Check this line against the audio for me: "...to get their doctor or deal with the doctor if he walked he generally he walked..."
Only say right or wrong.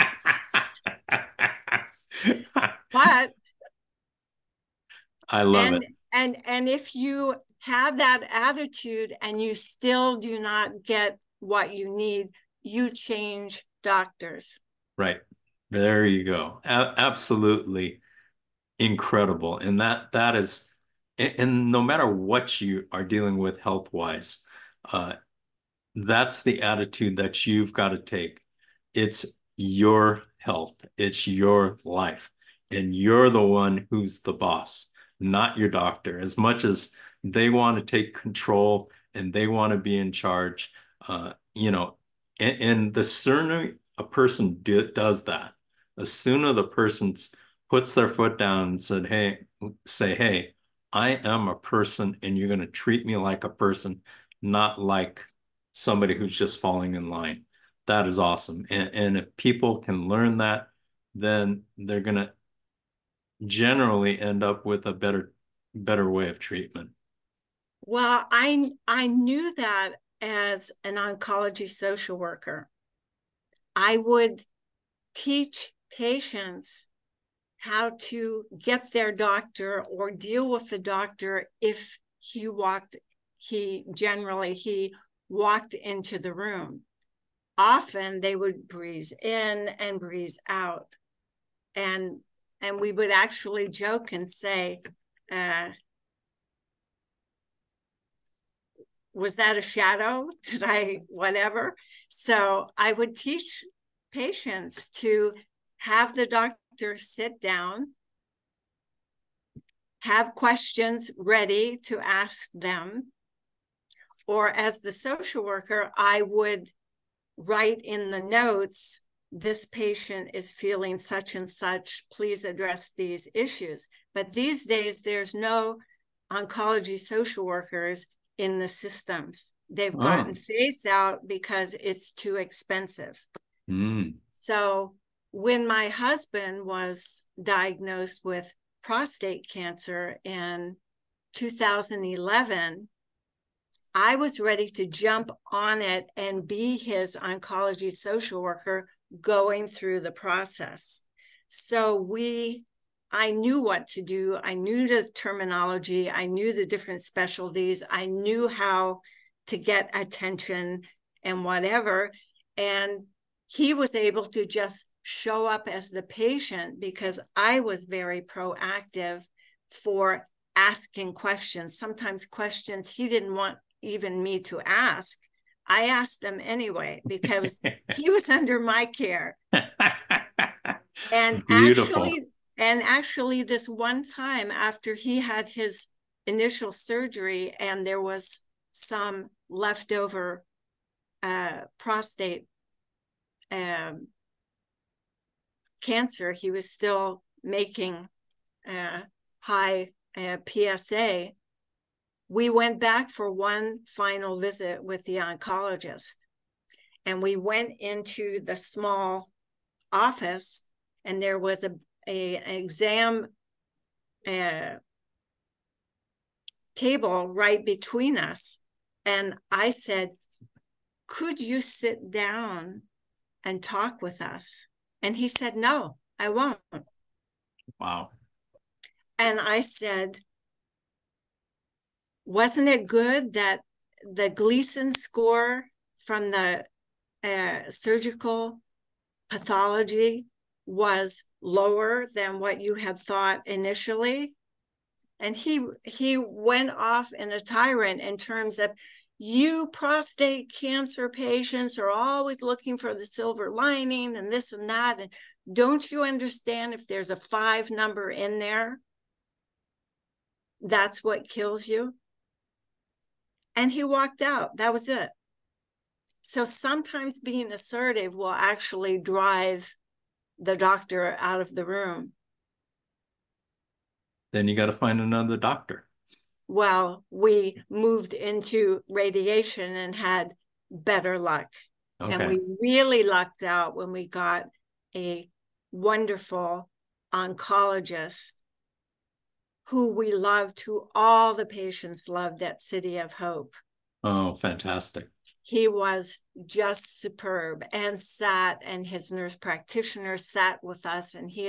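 right.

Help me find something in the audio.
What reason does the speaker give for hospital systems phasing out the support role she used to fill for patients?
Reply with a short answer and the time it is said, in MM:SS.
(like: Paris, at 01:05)
too expensive, at 02:12.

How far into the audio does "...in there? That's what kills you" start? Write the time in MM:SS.
04:18.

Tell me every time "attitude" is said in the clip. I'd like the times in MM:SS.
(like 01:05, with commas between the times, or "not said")
00:08, 00:26.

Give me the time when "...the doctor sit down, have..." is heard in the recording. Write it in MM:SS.
01:46.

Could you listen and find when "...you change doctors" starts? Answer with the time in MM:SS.
00:12.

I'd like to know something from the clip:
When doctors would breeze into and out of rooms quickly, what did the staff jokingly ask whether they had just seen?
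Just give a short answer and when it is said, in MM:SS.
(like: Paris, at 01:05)
a shadow, at 01:39.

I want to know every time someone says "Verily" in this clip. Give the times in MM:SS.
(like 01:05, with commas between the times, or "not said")
not said.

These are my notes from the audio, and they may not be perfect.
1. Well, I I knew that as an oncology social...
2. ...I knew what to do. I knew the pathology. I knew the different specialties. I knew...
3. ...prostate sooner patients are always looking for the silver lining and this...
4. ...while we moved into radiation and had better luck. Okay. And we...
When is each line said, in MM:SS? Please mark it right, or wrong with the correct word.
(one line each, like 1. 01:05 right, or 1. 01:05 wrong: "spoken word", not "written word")
1. 01:07 right
2. 02:33 wrong: "terminology", not "pathology"
3. 04:09 wrong: "cancer", not "sooner"
4. 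04:36 right.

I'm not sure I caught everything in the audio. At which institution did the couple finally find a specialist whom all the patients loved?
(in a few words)
City of Hope.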